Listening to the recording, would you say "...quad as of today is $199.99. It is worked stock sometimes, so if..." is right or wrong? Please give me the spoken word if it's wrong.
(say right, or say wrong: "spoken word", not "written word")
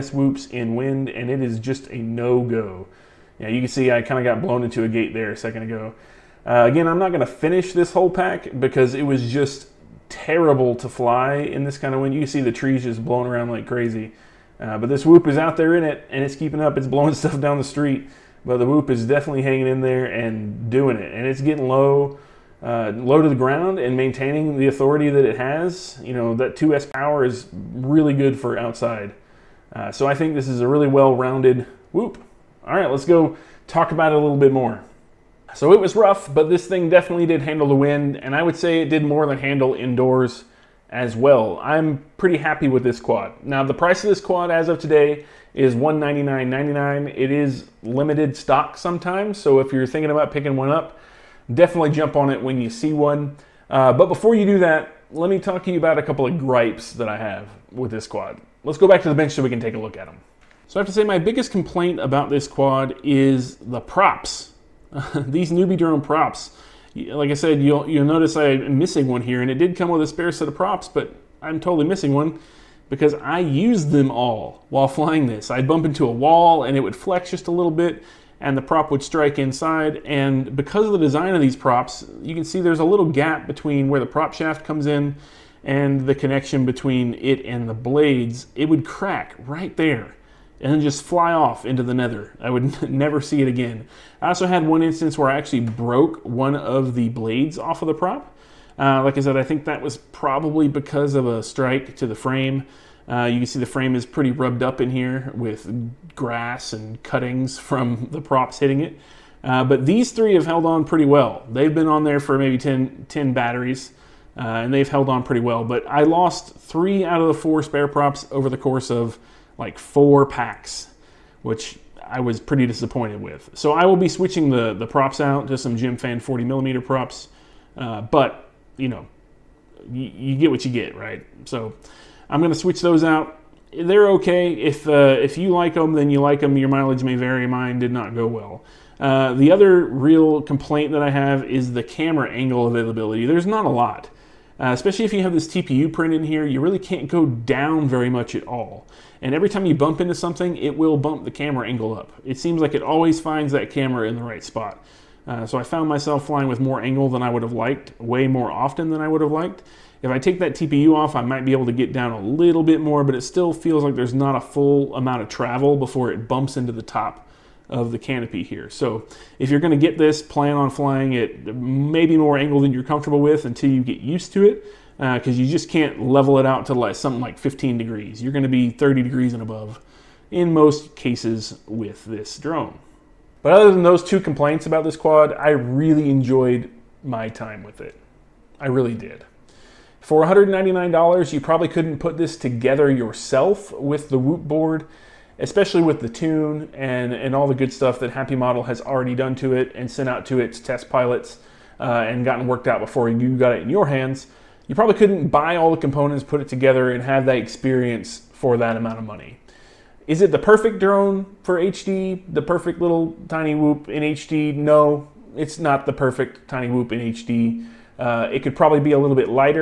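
wrong: "limited", not "worked".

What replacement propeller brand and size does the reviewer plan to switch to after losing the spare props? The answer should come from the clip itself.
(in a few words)
Gemfan 40 millimeter.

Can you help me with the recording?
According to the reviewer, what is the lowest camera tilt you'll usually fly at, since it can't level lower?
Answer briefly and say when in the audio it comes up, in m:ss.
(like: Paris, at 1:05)
30 degrees, at 2:58.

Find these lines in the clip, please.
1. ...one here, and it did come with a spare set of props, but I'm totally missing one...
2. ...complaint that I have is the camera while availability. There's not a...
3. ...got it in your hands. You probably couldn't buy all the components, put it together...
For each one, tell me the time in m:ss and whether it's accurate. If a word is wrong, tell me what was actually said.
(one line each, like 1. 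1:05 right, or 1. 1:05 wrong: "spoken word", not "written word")
1. 1:09 right
2. 2:20 wrong: "angle", not "while"
3. 3:23 right.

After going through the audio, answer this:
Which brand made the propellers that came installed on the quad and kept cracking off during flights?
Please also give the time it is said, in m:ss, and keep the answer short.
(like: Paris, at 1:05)
NewBeeDrone, at 1:05.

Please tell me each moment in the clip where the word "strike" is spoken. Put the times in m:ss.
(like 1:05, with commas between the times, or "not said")
1:19, 1:41.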